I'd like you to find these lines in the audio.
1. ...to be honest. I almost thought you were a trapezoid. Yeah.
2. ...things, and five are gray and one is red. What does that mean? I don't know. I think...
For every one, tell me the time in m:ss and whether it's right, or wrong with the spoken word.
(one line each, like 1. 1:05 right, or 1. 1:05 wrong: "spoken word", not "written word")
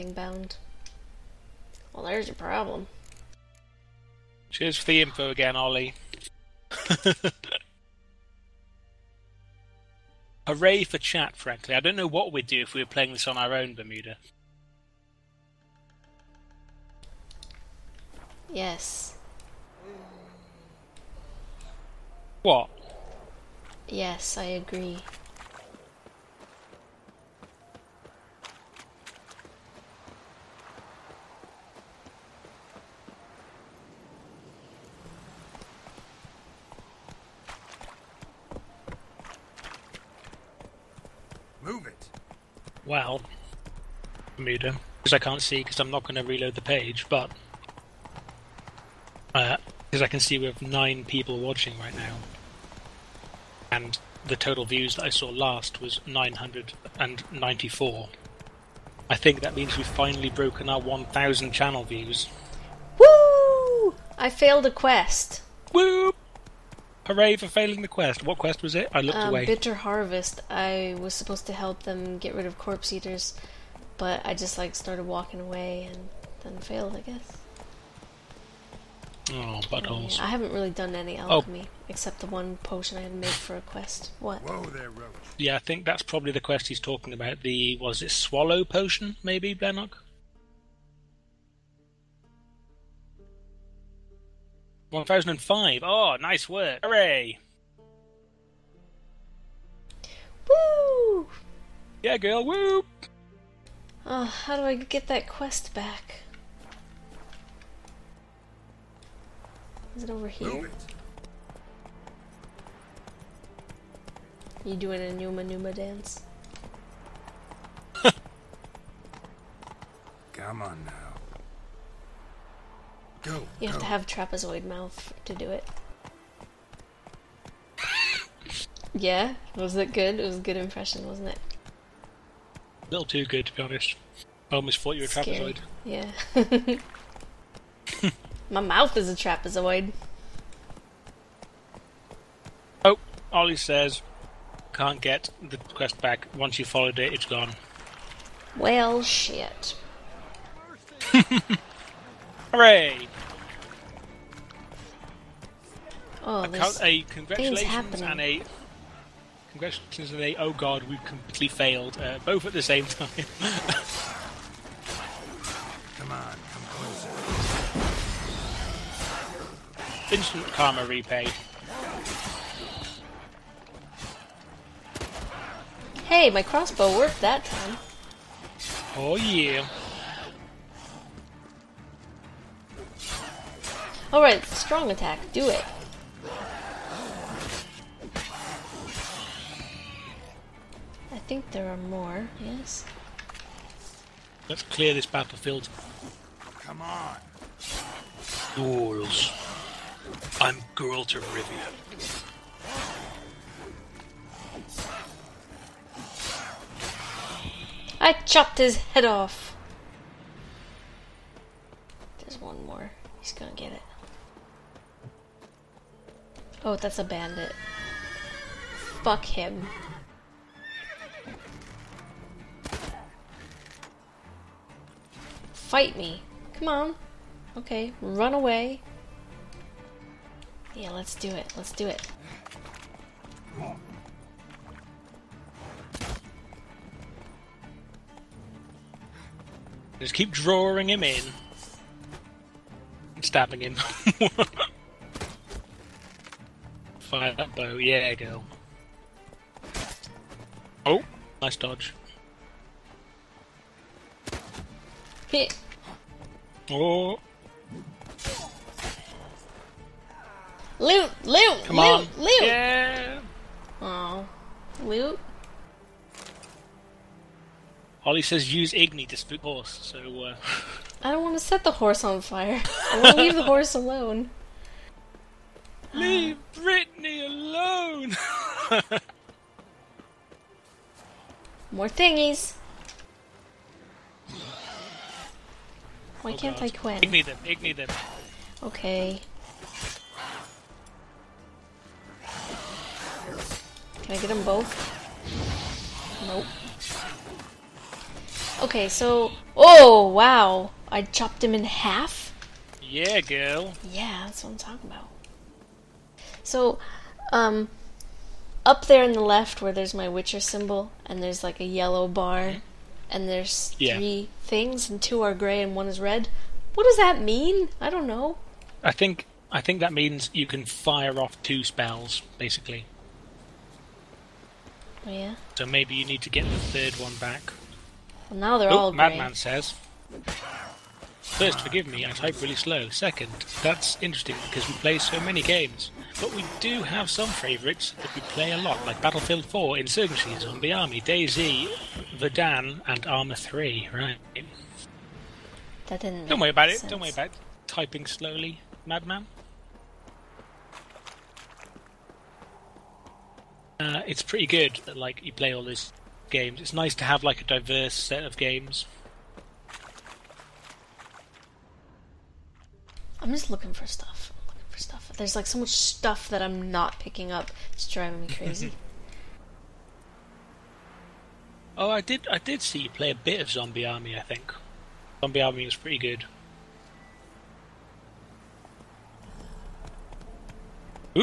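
1. 2:13 right
2. 5:14 wrong: "two", not "five".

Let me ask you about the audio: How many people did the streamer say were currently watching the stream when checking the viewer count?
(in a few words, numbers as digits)
9.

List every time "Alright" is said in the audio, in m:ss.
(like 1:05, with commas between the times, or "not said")
3:04.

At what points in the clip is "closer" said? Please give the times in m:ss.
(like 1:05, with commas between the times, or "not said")
2:46.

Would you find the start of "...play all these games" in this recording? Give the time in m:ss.
5:55.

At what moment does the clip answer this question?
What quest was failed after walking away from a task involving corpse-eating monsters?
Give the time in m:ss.
1:09.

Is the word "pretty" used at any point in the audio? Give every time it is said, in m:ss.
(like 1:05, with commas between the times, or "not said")
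5:54, 6:15.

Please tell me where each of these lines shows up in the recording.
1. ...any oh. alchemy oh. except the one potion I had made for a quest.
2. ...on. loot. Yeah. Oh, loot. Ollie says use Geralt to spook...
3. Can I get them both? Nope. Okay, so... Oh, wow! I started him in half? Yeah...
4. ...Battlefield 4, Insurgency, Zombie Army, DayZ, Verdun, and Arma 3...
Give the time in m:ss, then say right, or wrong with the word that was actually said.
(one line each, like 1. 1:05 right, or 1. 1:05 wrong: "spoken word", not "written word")
1. 1:20 right
2. 4:21 wrong: "Igni", not "Geralt"
3. 4:54 wrong: "chopped", not "started"
4. 5:39 right.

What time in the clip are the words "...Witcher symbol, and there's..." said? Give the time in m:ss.
5:10.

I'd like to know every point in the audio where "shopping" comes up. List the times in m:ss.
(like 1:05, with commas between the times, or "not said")
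not said.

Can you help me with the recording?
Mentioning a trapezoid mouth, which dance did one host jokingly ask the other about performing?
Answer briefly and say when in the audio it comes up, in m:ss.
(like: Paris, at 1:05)
Numa Numa, at 1:55.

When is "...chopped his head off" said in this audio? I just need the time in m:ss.
3:28.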